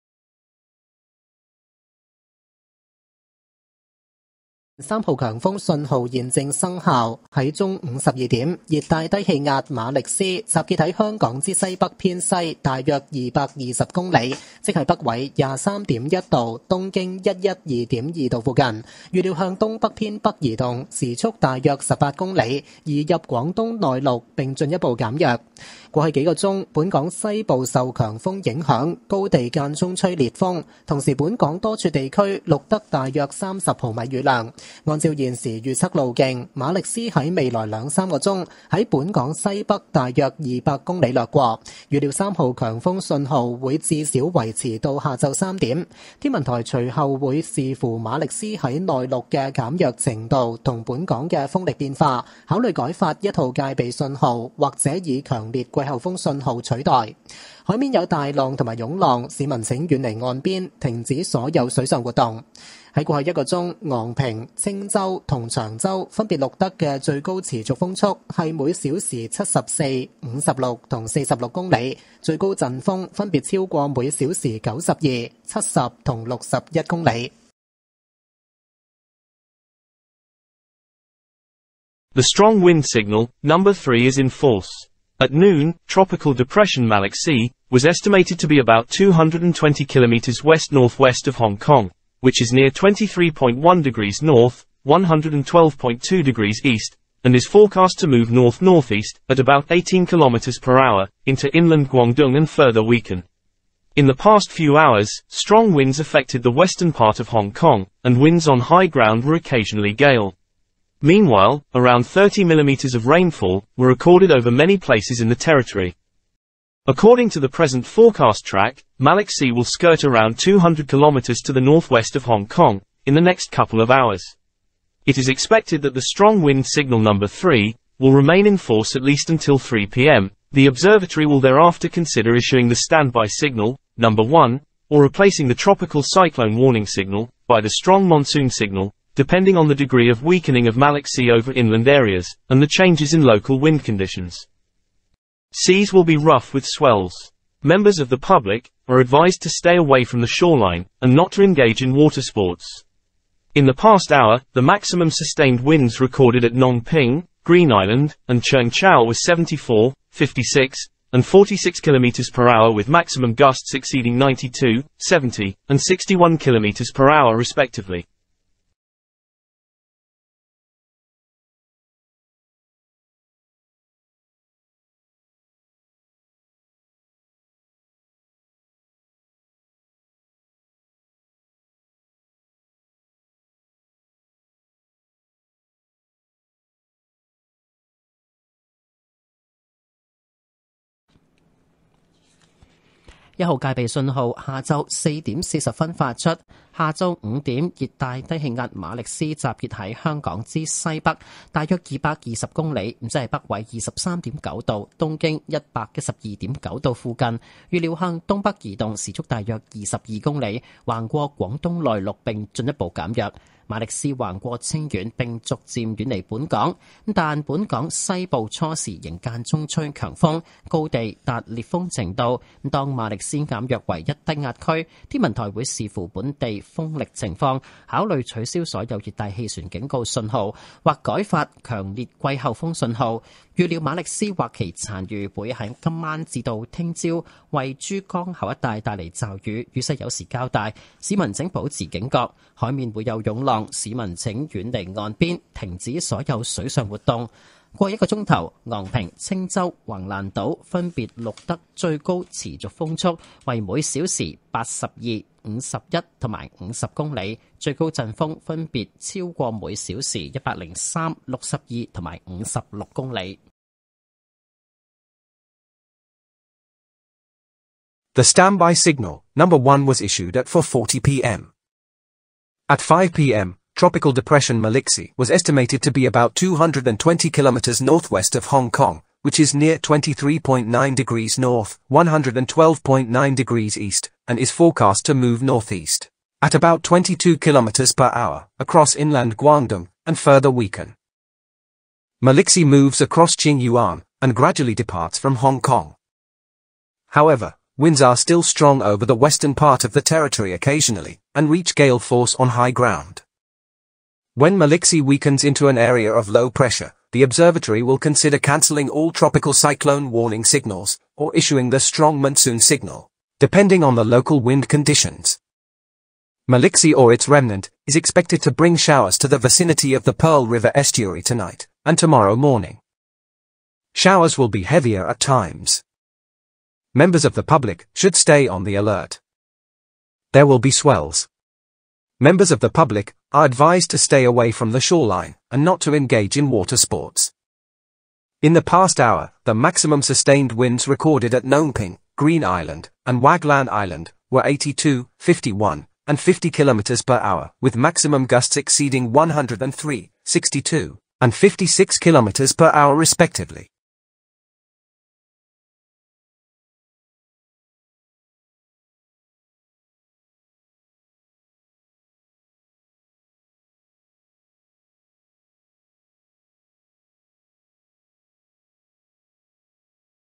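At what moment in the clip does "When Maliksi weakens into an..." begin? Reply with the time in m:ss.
5:04.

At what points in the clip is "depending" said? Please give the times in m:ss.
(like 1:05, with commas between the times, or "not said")
2:19, 5:13.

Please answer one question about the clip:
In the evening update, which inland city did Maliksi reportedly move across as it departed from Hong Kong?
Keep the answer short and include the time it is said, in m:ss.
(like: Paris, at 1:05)
Qingyuan, at 4:53.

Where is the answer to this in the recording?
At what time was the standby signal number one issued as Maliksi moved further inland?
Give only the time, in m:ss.
4:30.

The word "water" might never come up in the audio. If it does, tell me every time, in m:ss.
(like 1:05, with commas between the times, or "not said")
2:31, 5:36.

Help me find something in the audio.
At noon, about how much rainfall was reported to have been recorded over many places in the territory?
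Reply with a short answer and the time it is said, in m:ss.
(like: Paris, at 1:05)
30 millimeters, at 1:51.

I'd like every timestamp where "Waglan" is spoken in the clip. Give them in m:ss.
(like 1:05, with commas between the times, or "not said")
5:43.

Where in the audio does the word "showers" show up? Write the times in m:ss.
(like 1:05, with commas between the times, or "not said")
5:18, 5:23.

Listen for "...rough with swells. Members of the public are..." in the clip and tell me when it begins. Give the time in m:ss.
2:26.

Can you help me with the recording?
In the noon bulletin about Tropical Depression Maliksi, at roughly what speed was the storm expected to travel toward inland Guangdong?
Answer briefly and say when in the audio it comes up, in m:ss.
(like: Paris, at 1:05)
18 km/h, at 1:39.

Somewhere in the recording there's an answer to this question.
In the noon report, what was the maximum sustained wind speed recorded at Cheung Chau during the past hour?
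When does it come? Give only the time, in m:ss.
2:41.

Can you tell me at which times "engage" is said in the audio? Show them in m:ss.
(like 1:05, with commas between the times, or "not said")
2:31, 5:35.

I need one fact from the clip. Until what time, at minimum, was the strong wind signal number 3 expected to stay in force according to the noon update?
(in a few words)
3 p.m.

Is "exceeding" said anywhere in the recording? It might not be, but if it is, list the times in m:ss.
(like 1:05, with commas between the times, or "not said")
2:43, 5:48.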